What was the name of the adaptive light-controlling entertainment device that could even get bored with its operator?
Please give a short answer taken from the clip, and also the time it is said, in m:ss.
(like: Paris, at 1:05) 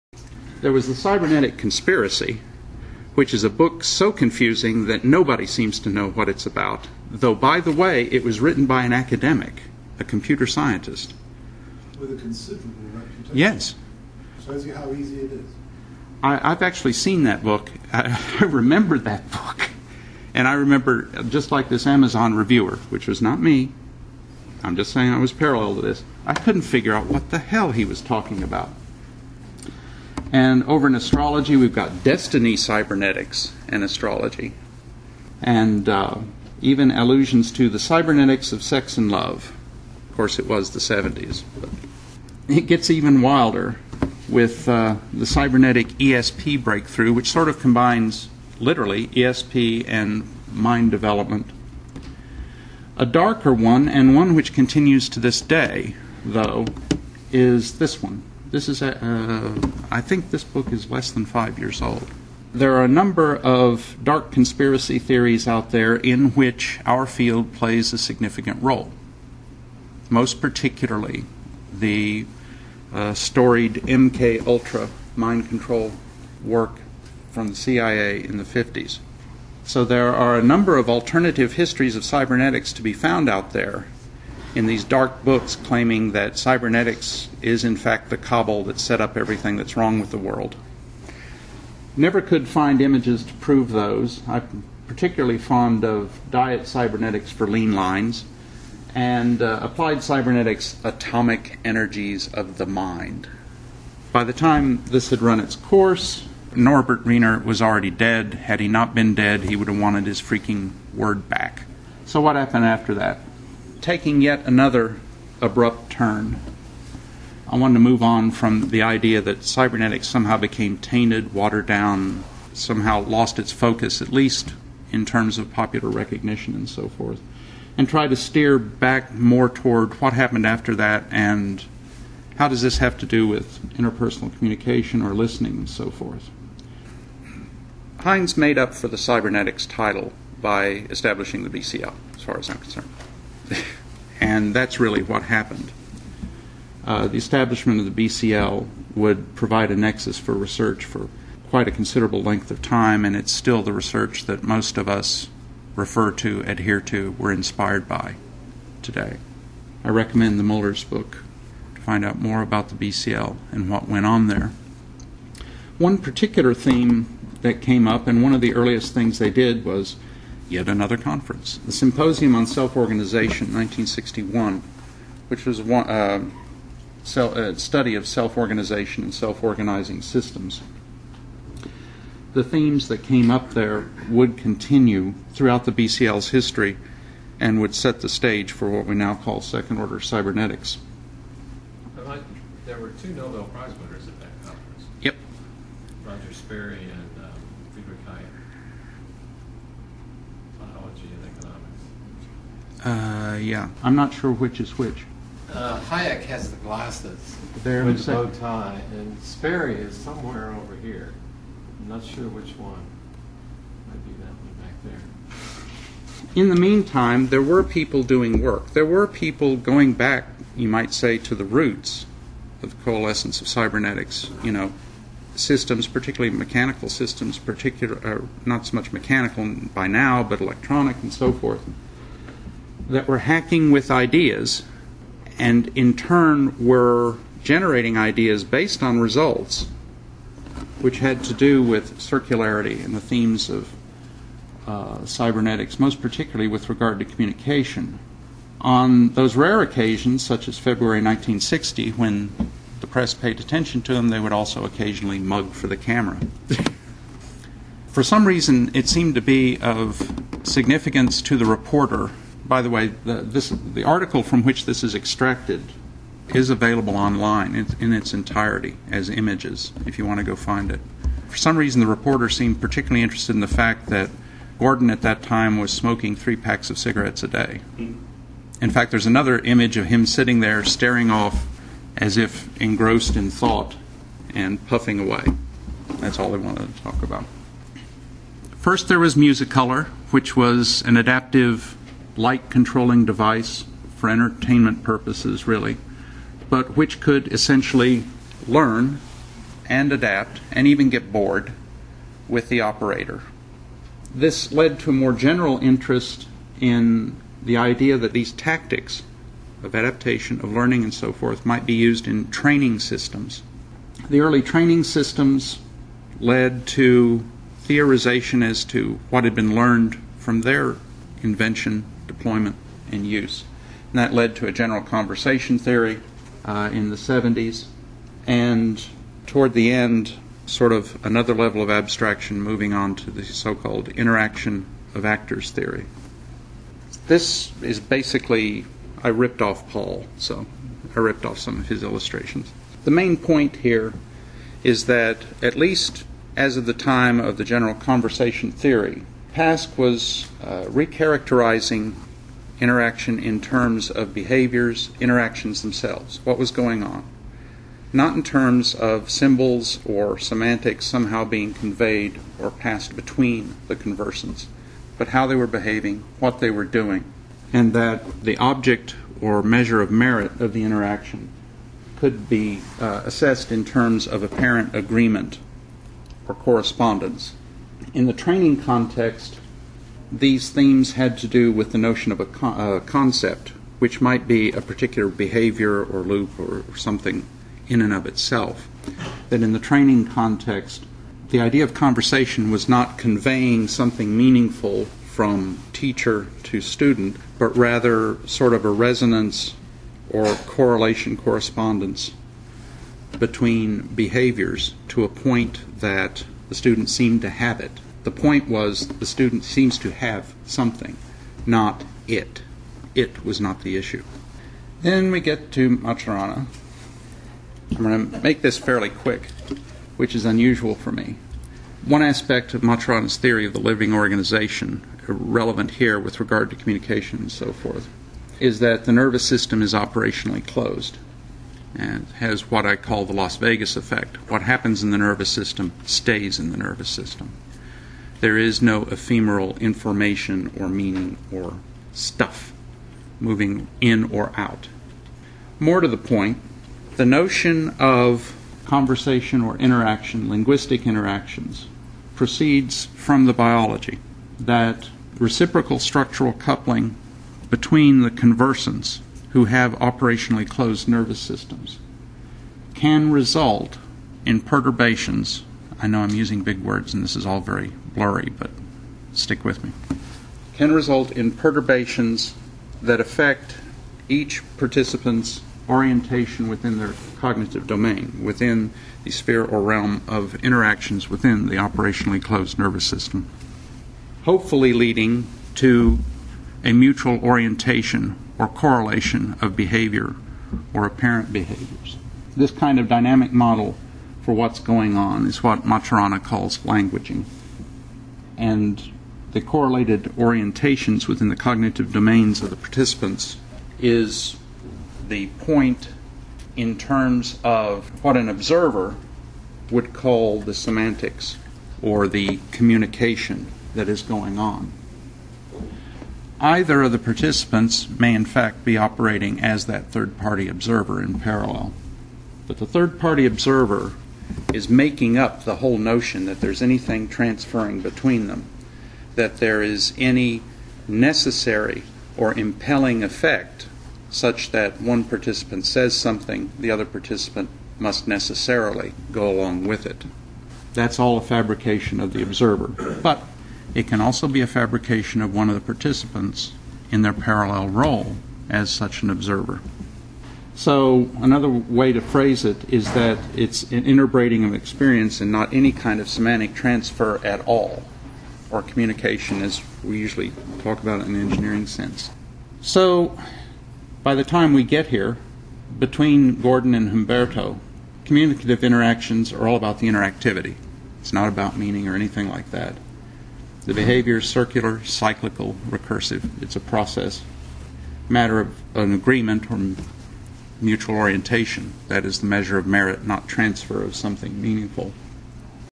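Musicolor, at 4:49.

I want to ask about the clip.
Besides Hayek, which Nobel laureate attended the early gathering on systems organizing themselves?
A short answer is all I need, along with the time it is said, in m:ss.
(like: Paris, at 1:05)
Roger Sperry, at 3:16.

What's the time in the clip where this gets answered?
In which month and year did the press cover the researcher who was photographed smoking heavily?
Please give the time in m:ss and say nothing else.
4:10.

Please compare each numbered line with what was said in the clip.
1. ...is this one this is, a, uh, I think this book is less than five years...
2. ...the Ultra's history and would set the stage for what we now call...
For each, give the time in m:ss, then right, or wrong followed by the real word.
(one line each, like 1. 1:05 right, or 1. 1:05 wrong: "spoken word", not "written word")
1. 0:57 right
2. 3:05 wrong: "BCL", not "Ultra".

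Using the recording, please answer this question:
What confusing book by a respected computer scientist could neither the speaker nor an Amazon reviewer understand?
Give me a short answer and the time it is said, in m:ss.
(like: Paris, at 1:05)
The Cybernetic Conspiracy, at 0:00.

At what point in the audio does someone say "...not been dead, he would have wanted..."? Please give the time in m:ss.
1:48.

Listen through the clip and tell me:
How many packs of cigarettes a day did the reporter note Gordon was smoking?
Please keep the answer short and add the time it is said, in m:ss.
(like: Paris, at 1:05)
3, at 4:36.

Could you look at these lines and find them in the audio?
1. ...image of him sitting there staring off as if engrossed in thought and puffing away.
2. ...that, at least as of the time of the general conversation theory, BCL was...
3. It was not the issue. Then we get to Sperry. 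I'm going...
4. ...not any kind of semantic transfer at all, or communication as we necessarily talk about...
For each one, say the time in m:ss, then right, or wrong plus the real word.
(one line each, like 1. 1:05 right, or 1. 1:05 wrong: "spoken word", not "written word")
1. 4:39 right
2. 5:44 wrong: "Pask", not "BCL"
3. 6:52 wrong: "Maturana", not "Sperry"
4. 9:15 wrong: "usually", not "necessarily".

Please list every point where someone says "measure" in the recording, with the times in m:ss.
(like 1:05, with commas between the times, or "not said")
6:09, 9:42.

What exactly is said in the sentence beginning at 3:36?
In the meantime, there were people doing work.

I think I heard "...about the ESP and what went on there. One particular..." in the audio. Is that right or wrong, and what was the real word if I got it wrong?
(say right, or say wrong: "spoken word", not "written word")
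wrong: "BCL", not "ESP".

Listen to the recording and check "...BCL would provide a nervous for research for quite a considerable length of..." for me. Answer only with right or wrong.
wrong.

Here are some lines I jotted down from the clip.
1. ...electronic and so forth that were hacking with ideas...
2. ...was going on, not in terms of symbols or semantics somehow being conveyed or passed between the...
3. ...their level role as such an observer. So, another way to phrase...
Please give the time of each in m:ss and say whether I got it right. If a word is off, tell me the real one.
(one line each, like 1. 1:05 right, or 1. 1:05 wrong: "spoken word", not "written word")
1. 3:50 right
2. 5:56 right
3. 9:07 wrong: "parallel", not "level".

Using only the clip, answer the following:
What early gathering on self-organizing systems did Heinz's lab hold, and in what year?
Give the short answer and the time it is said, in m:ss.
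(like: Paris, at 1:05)
Symposium on Self Organization, 1961, at 2:51.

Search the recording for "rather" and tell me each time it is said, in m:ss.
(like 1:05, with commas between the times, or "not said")
6:37.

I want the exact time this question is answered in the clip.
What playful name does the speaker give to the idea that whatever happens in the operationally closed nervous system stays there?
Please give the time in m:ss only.
7:13.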